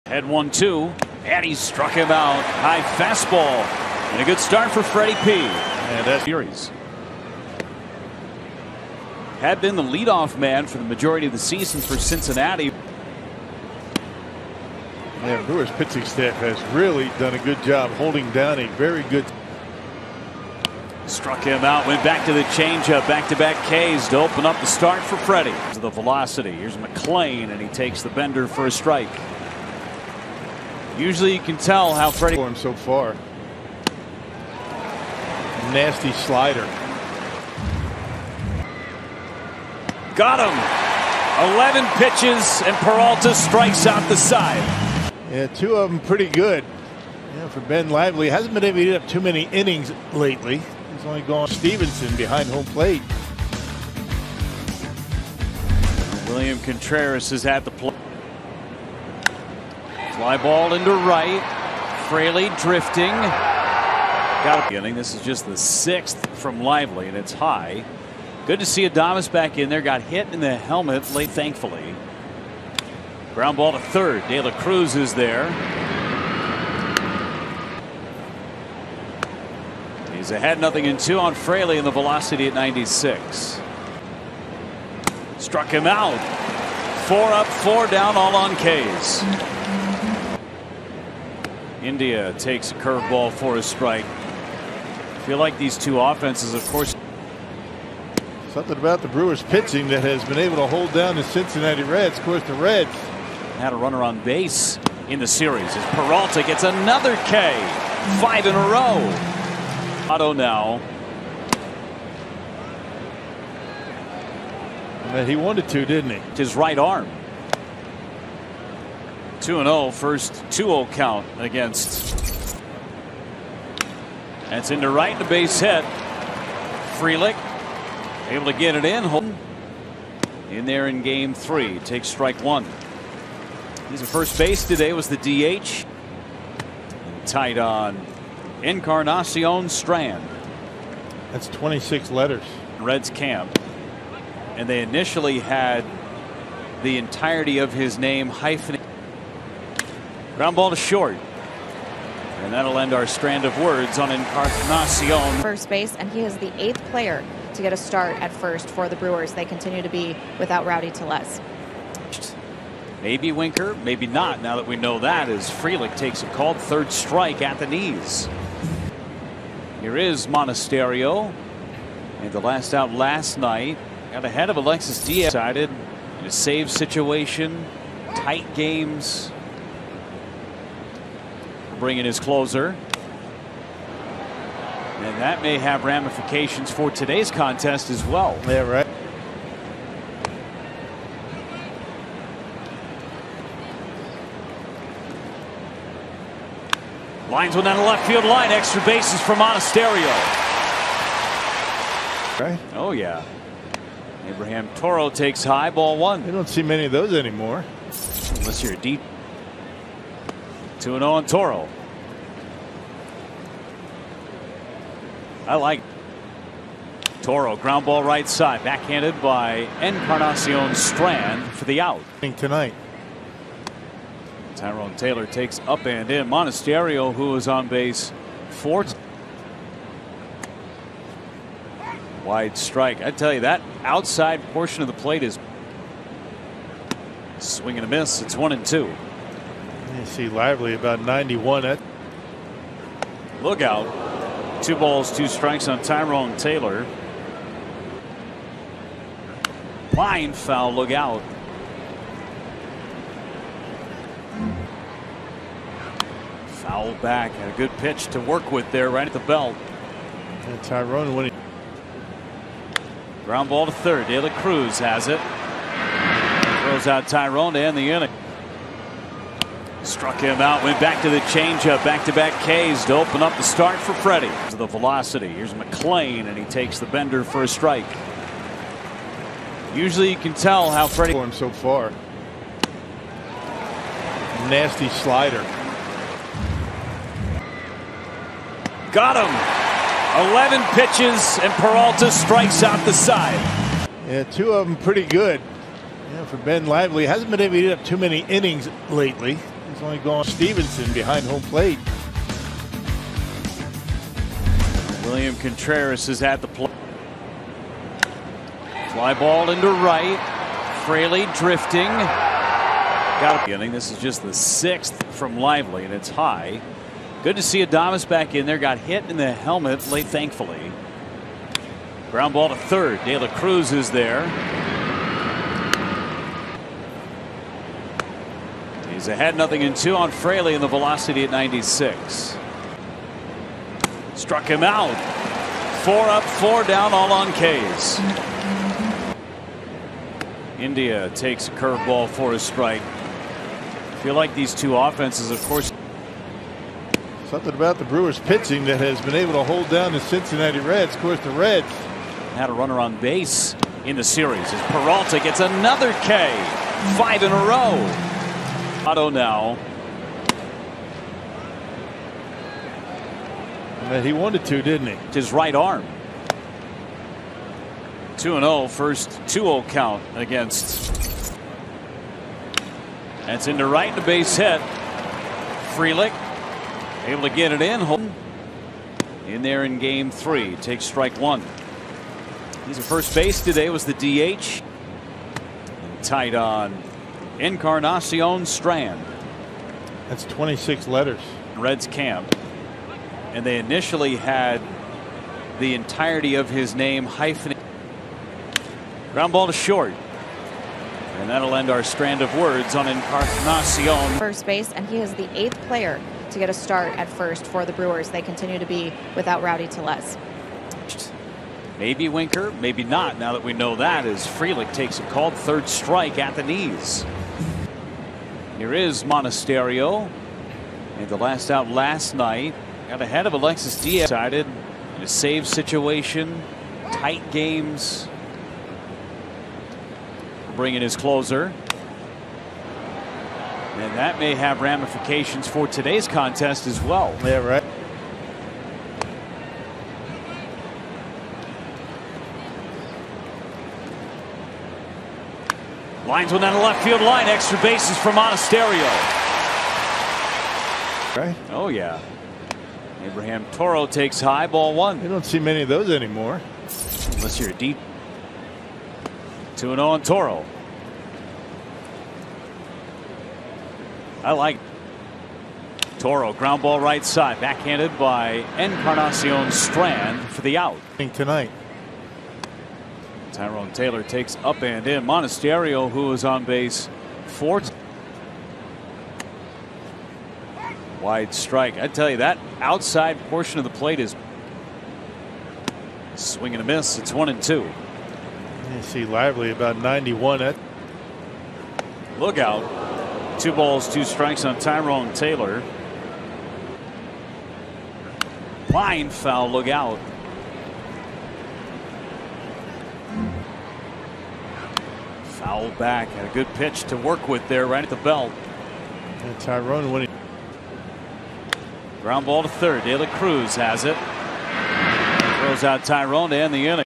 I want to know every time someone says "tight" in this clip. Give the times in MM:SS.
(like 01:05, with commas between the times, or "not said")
02:17, 02:58, 06:26, 07:06.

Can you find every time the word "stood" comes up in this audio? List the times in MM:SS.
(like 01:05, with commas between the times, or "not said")
not said.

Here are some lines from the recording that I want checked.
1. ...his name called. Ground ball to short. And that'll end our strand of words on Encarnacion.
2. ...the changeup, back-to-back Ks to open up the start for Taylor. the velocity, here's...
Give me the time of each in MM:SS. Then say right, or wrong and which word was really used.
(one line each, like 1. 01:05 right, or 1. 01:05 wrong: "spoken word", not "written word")
1. 02:27 wrong: "hyphenated", not "called"
2. 04:31 wrong: "Freddy", not "Taylor".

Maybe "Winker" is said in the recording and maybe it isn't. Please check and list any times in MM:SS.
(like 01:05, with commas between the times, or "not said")
02:43, 06:52.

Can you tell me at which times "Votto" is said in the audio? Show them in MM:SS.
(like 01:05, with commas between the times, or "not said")
01:50, 05:58.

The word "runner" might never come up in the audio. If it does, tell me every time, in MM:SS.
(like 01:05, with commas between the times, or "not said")
01:43, 05:52.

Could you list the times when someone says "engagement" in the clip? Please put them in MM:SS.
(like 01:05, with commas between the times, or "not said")
not said.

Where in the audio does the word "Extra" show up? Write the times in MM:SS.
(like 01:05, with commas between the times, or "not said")
03:18, 07:27.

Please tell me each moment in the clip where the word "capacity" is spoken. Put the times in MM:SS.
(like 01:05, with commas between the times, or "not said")
not said.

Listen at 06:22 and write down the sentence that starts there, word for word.
He's at first base today, was the DH.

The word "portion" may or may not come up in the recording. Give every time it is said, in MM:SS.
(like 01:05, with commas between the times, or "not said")
03:54, 08:03.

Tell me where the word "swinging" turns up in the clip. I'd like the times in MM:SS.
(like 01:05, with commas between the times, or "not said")
03:57, 08:06.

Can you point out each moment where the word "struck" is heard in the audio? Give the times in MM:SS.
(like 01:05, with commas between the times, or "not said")
00:01, 00:21, 01:25, 04:29, 05:34.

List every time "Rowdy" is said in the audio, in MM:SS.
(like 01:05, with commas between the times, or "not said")
02:40, 06:49.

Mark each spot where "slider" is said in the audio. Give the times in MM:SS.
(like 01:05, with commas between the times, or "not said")
00:36, 04:44.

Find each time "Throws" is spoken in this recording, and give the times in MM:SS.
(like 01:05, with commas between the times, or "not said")
04:26, 08:35.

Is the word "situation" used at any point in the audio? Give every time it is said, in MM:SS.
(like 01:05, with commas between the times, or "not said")
02:56, 07:05.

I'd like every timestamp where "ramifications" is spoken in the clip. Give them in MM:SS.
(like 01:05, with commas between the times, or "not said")
03:05, 07:14.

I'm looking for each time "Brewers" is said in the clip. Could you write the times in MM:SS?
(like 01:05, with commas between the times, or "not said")
00:15, 01:39, 02:38, 05:47, 06:47.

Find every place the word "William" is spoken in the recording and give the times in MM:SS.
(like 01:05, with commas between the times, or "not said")
00:56, 05:05.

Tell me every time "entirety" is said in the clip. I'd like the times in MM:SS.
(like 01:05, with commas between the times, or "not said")
02:26, 06:35.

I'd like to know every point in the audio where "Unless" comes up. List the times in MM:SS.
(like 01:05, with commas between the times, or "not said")
03:28, 07:37.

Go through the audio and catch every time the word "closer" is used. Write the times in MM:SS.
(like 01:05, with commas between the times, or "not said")
03:02, 07:10.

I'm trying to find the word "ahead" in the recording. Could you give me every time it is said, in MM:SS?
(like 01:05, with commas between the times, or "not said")
01:20, 02:54, 05:29, 07:03.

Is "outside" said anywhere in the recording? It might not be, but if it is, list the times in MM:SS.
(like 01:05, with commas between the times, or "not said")
03:53, 08:02.